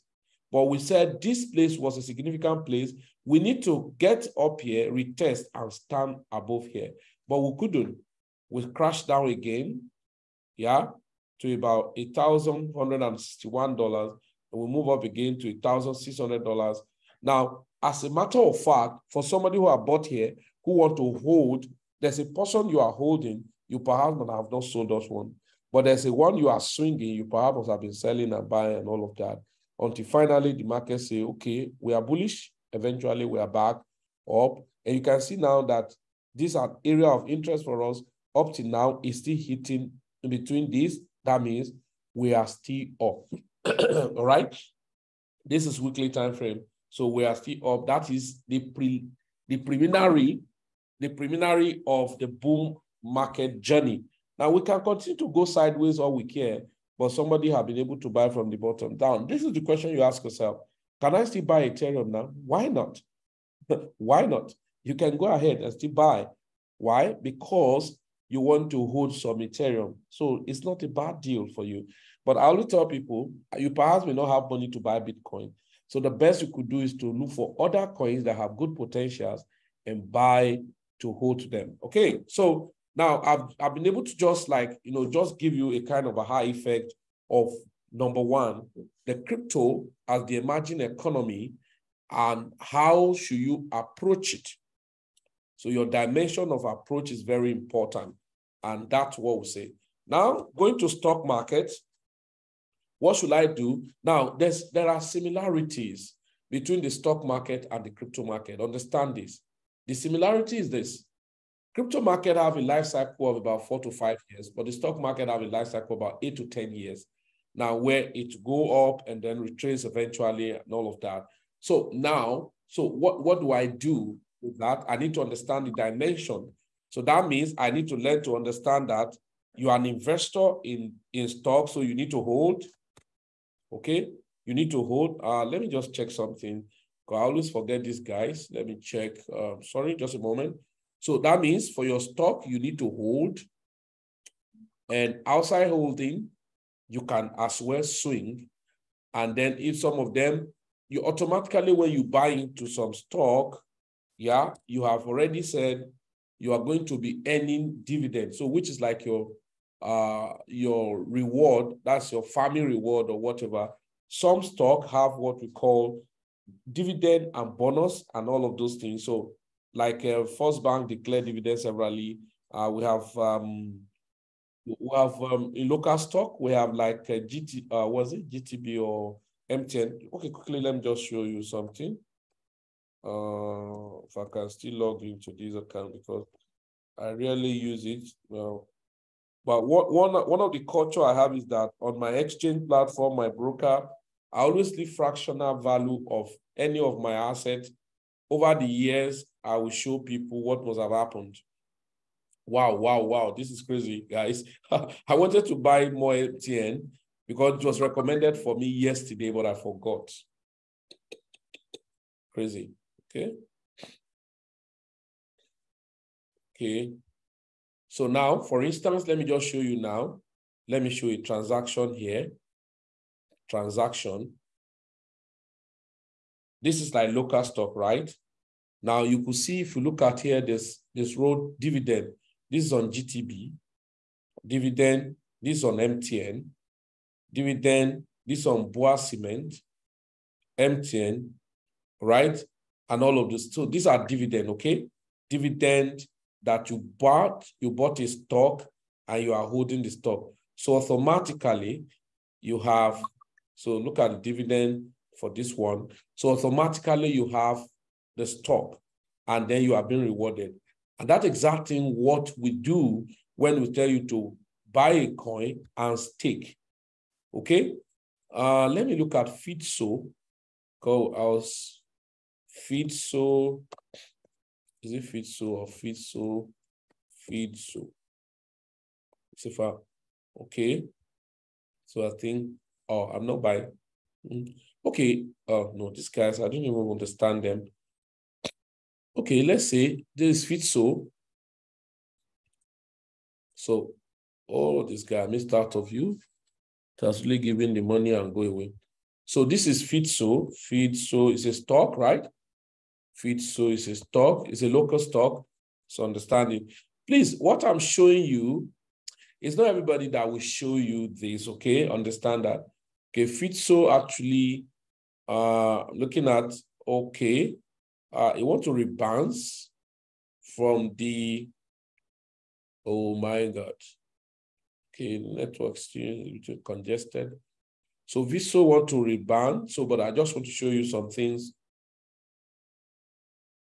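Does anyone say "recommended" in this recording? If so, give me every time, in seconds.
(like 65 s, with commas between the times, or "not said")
207 s.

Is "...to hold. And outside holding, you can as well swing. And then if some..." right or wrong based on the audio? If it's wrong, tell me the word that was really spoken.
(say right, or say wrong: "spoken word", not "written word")
right.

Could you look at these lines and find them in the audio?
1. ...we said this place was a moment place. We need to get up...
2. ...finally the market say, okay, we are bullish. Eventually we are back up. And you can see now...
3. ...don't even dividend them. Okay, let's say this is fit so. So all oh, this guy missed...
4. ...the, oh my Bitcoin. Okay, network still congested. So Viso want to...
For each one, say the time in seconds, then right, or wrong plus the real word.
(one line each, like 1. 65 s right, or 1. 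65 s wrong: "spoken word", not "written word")
1. 0 s wrong: "significant", not "moment"
2. 30 s right
3. 286 s wrong: "understand", not "dividend"
4. 320 s wrong: "God", not "Bitcoin".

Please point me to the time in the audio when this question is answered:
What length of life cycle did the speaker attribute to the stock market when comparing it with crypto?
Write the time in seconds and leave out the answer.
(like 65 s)
116 s.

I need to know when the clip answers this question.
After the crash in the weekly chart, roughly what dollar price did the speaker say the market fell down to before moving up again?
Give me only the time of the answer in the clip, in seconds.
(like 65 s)
11 s.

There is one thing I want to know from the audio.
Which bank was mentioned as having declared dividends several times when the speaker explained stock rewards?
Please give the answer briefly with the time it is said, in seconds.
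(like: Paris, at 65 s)
First Bank, at 170 s.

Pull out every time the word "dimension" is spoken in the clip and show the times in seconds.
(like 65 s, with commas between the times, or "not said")
95 s, 125 s.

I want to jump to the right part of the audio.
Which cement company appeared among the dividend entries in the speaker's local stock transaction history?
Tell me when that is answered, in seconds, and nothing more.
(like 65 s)
238 s.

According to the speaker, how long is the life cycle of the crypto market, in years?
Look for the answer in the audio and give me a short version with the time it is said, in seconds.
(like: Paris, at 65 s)
4 to 5 years, at 113 s.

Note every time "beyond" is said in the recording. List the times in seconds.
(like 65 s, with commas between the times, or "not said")
not said.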